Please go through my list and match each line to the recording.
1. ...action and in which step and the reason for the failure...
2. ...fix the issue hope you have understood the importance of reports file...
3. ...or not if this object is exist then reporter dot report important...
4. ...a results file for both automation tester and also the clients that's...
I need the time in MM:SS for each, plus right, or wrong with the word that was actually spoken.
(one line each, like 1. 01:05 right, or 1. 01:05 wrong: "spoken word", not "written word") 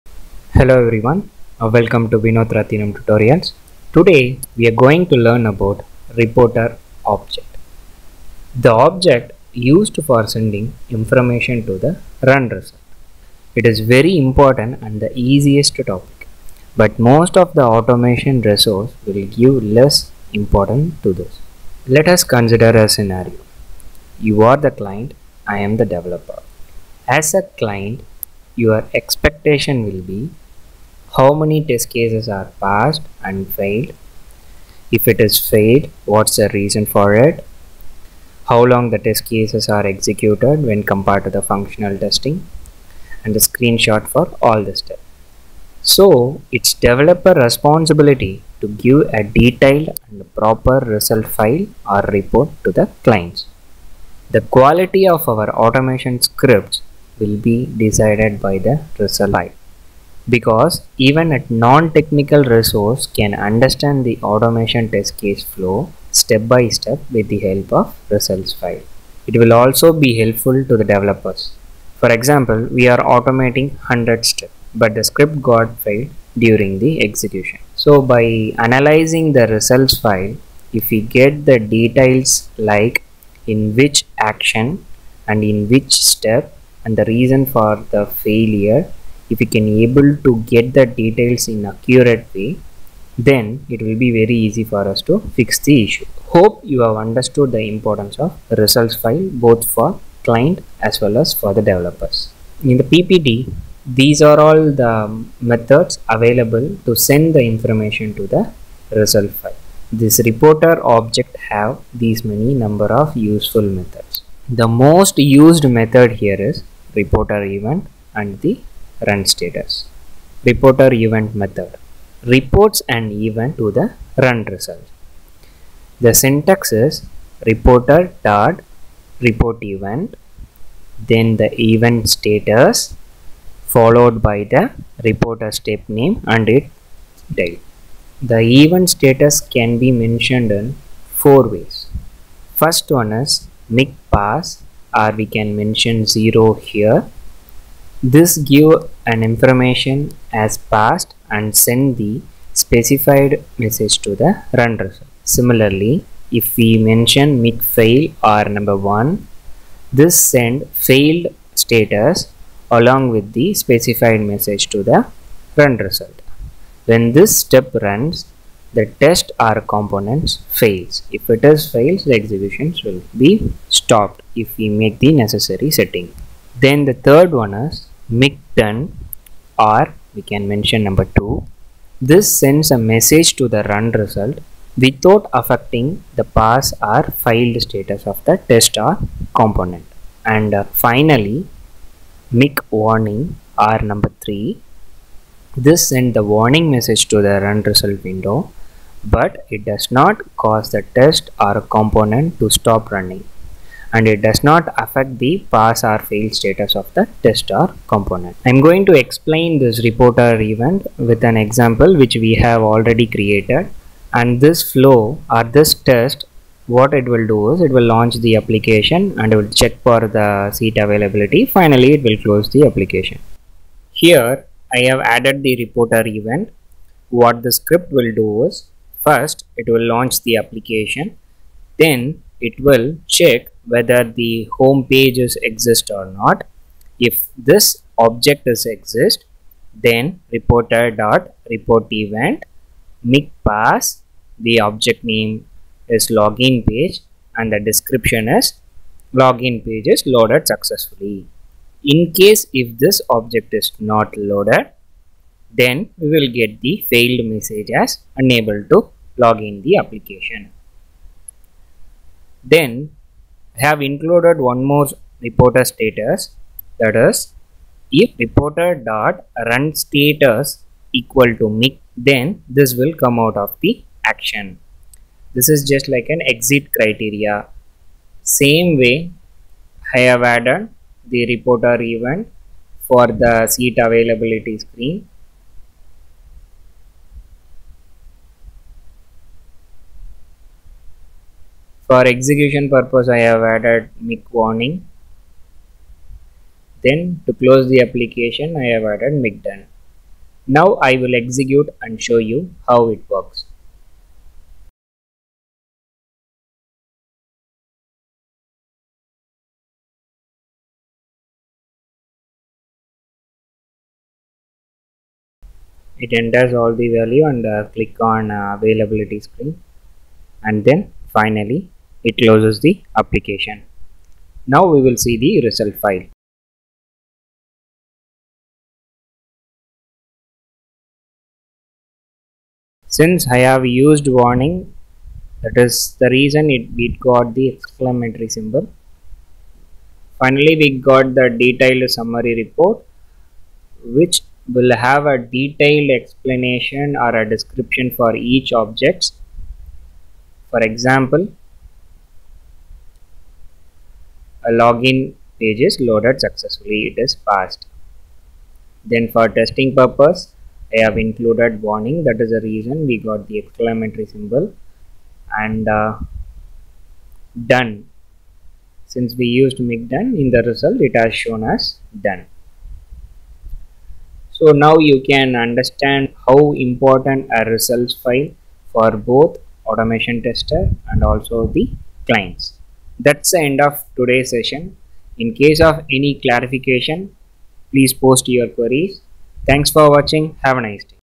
1. 01:24 right
2. 01:35 wrong: "results", not "reports"
3. 03:55 wrong: "event", not "important"
4. 06:17 right.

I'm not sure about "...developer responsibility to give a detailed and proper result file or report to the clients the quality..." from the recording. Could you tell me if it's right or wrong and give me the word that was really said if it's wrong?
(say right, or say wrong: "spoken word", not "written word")
right.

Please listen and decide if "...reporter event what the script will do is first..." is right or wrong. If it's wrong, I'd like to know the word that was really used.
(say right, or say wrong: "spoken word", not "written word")
right.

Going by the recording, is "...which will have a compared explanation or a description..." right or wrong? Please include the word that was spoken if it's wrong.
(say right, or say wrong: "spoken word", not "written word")
wrong: "detailed", not "compared".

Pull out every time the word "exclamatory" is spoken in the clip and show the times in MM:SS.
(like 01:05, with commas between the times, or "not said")
05:37, 06:03.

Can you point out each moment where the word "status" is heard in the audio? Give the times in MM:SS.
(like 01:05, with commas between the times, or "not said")
01:59, 02:12, 02:18, 02:41, 03:07, 03:26, 04:25, 04:29.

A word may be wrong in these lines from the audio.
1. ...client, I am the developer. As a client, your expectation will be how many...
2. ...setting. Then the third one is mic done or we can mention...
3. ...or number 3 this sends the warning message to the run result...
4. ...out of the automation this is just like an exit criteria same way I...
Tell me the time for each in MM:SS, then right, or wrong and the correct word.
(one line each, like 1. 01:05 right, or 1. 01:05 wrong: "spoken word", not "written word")
1. 00:24 right
2. 02:55 right
3. 03:13 right
4. 04:33 wrong: "action", not "automation".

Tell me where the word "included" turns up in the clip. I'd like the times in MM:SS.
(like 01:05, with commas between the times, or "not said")
04:23, 06:00.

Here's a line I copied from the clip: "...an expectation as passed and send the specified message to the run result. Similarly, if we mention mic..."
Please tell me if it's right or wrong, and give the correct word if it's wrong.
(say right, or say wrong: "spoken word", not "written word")
wrong: "information", not "expectation".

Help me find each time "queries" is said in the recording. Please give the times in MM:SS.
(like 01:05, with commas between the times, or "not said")
06:28.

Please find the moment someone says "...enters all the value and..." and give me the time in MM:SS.
05:16.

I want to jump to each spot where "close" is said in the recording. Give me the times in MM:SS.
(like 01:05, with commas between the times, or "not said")
03:42, 04:57, 05:22.